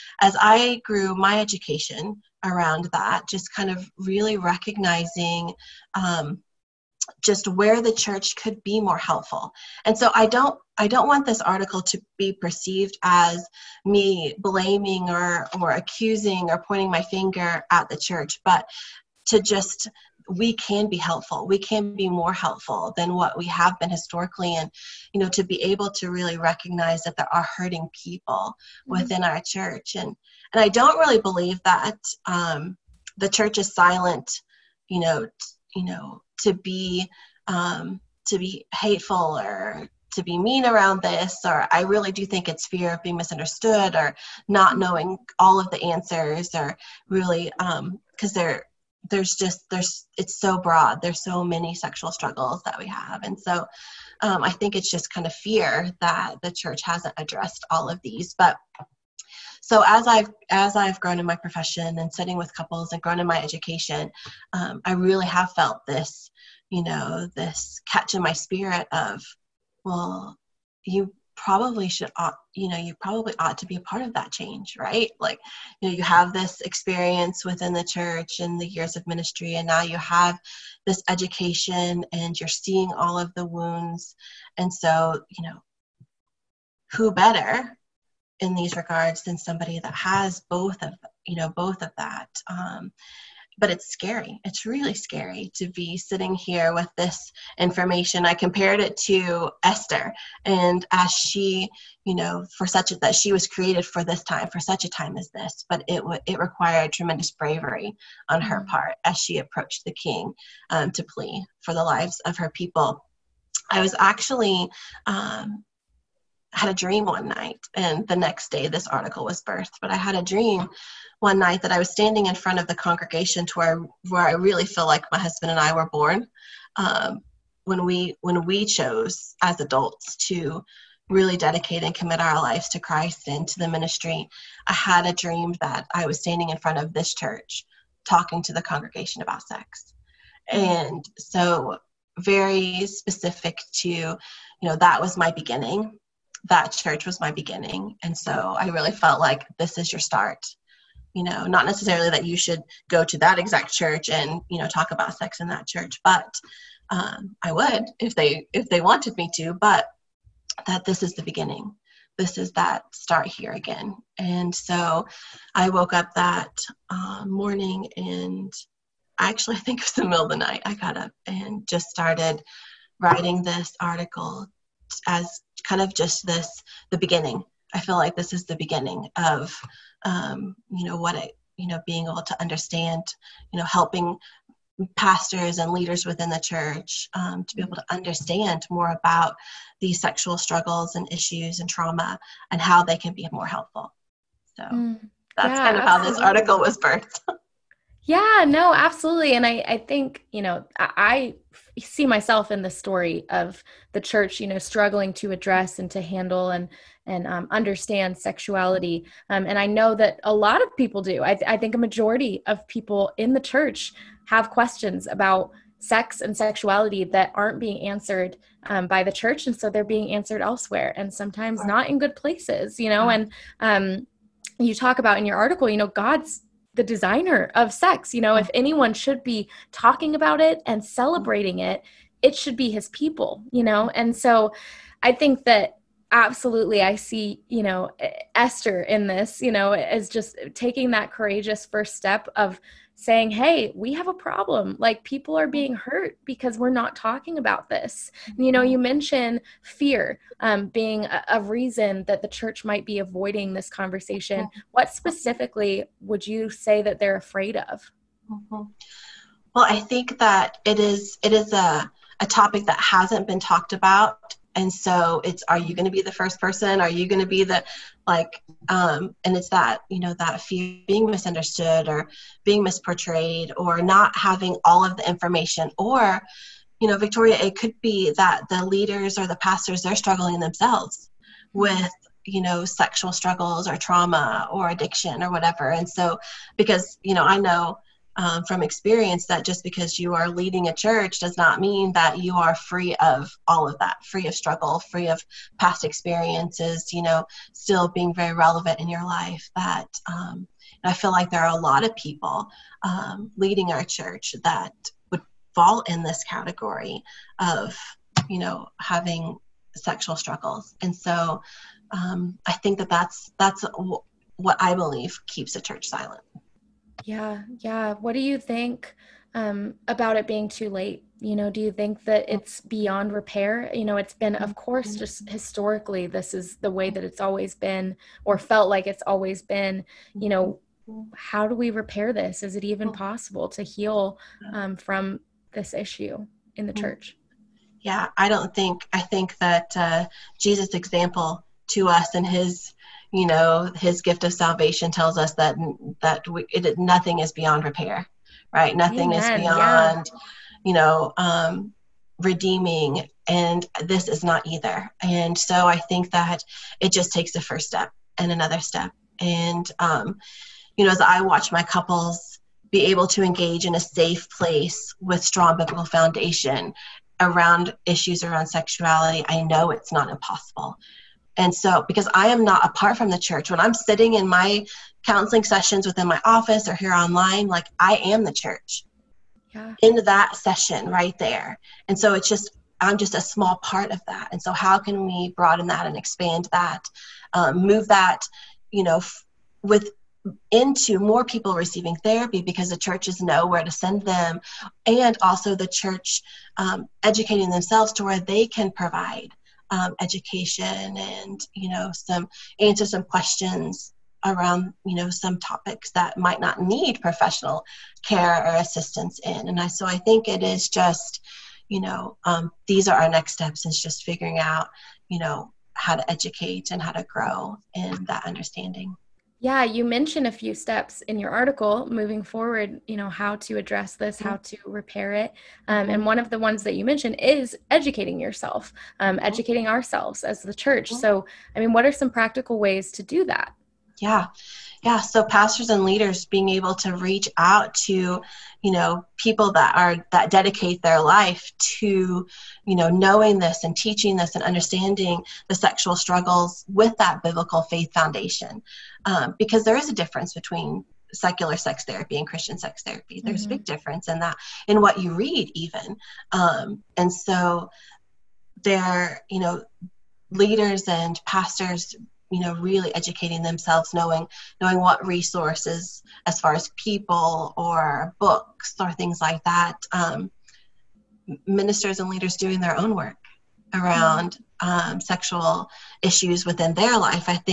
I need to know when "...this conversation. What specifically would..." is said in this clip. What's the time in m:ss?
4:13.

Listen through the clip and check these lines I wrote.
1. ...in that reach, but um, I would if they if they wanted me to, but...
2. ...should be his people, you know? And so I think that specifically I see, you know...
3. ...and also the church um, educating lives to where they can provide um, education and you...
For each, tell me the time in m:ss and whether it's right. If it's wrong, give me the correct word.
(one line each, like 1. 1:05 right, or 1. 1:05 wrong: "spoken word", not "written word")
1. 2:35 wrong: "church", not "reach"
2. 3:52 wrong: "absolutely", not "specifically"
3. 6:34 wrong: "themselves", not "lives".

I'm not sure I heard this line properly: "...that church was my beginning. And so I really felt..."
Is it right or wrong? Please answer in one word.
right.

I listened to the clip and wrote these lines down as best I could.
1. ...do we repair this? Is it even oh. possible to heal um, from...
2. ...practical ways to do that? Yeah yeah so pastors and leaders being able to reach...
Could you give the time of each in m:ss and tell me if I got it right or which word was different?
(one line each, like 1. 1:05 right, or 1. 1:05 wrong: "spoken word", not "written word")
1. 5:31 right
2. 7:12 right.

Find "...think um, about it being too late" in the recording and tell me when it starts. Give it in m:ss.
5:18.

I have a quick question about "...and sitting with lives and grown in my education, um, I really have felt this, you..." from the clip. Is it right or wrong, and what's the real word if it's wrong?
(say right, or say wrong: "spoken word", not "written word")
wrong: "couples", not "lives".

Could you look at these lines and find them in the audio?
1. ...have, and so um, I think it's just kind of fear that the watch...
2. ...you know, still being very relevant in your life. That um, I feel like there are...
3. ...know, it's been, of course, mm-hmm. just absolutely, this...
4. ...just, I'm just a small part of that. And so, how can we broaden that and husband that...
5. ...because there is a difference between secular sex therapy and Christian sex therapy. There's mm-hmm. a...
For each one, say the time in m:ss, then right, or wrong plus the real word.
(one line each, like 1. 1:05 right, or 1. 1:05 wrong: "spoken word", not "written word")
1. 0:52 wrong: "church", not "watch"
2. 4:56 right
3. 5:23 wrong: "historically", not "absolutely"
4. 6:22 wrong: "expand", not "husband"
5. 7:29 right.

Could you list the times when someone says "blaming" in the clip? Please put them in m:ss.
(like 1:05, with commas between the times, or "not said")
0:14.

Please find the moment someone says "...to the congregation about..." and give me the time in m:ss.
2:18.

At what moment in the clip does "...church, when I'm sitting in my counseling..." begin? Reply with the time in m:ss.
6:13.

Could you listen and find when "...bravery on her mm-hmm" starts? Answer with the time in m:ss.
1:47.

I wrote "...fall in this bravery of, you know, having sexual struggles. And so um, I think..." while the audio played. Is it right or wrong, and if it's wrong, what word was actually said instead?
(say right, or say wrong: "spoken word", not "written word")
wrong: "category", not "bravery".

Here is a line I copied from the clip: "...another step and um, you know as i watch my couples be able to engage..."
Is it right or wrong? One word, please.
right.